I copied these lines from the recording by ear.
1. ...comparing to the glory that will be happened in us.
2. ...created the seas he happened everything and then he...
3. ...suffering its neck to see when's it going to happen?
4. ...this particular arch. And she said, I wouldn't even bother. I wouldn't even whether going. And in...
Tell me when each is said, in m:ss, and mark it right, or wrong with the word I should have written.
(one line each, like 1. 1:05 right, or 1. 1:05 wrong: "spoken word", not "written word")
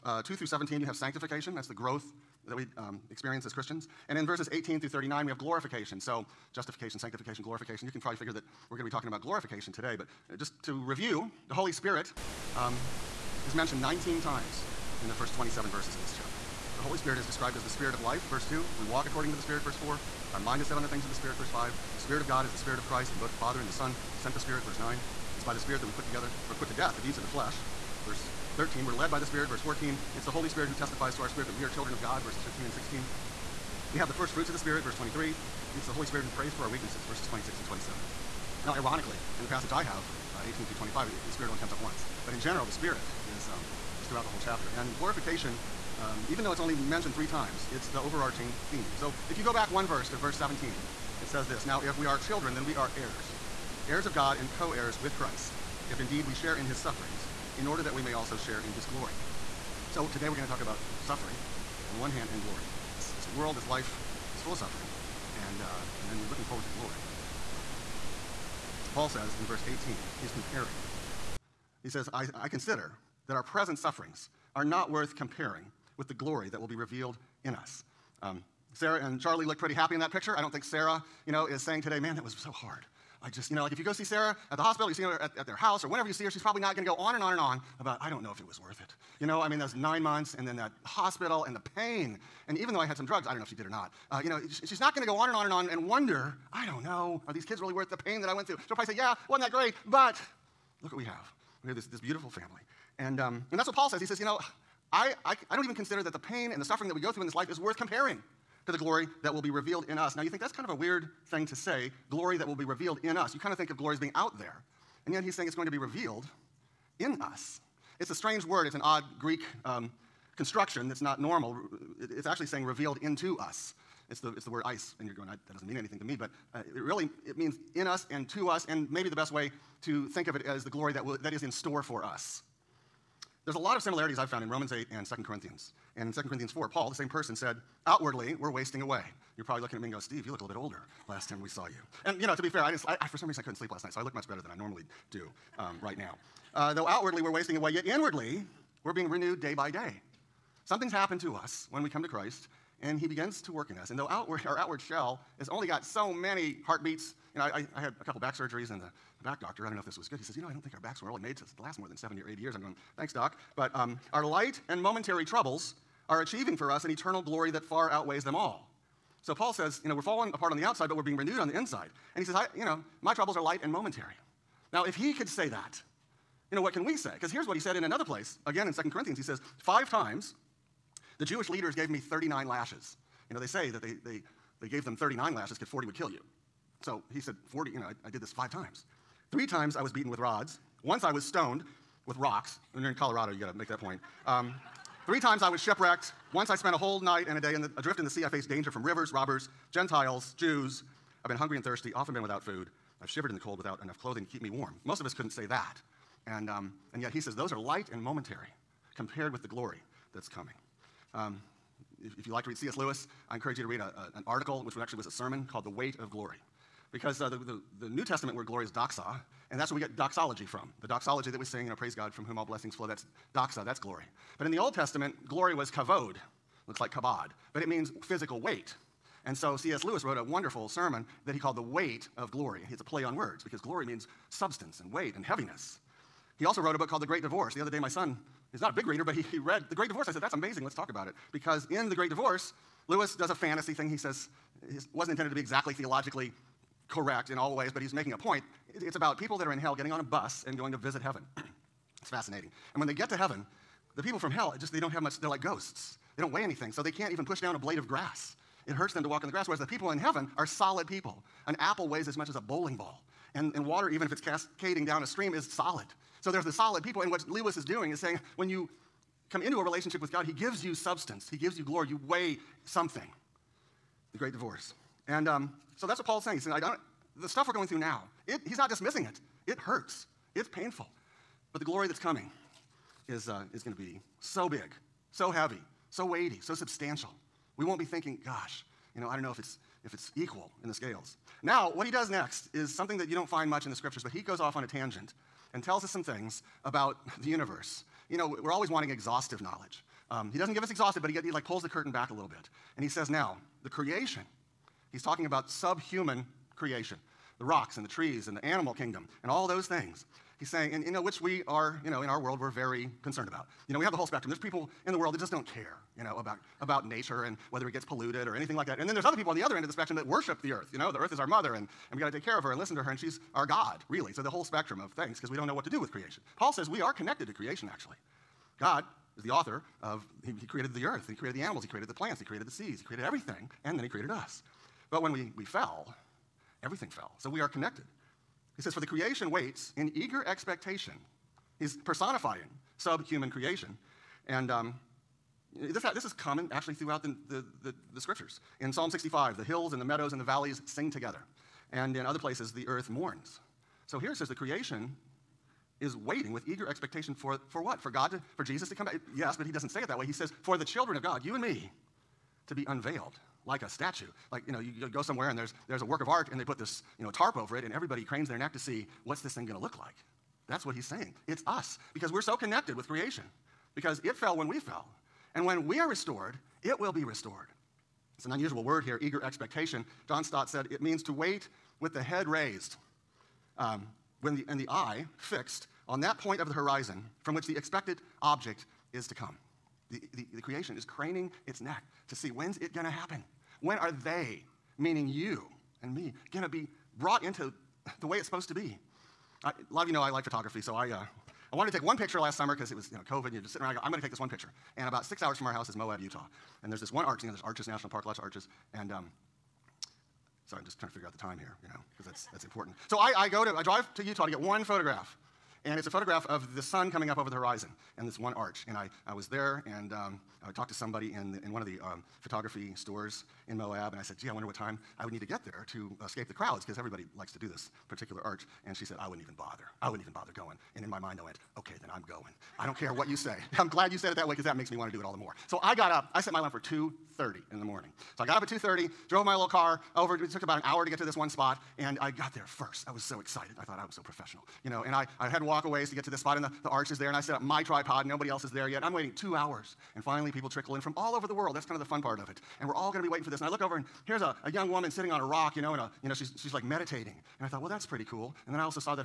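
1. 1:47 wrong: "revealed", not "happened"
2. 5:32 wrong: "created", not "happened"
3. 6:30 wrong: "craning", not "suffering"
4. 7:07 wrong: "bother", not "whether".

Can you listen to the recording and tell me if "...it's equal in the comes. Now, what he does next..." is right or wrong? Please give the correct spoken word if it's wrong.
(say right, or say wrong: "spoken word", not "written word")
wrong: "scales", not "comes".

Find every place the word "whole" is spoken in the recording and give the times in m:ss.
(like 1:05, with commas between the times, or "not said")
0:44, 3:16, 5:13, 5:24.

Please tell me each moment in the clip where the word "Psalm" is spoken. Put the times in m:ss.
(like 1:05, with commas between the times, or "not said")
5:48.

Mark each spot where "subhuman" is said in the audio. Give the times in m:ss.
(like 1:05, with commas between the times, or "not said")
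5:05, 5:42.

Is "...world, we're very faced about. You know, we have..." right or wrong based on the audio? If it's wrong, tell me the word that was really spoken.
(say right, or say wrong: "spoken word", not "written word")
wrong: "concerned", not "faced".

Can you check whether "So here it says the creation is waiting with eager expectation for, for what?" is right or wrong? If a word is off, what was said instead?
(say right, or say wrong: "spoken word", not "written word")
right.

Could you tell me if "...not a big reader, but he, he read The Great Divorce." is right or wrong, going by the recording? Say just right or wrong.
right.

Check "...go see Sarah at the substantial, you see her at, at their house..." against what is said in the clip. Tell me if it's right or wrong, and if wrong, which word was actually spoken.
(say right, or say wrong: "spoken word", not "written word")
wrong: "hospital", not "substantial".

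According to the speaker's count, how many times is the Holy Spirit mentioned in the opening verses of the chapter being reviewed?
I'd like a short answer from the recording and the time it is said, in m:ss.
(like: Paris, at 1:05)
19, at 0:13.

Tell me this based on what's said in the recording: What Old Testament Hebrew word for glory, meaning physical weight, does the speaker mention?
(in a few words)
kavod.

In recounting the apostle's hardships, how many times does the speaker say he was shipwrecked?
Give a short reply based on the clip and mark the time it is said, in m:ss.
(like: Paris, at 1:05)
3, at 3:15.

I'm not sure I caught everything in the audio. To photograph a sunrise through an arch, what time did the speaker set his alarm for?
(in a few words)
2:30 a.m.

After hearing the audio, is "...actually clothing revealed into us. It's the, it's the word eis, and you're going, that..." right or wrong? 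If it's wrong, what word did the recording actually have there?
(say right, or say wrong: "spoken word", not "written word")
wrong: "saying", not "clothing".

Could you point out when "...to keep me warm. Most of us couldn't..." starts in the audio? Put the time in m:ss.
3:24.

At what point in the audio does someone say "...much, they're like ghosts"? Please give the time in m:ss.
4:15.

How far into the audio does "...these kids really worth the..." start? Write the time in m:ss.
1:37.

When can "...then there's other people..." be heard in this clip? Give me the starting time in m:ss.
5:18.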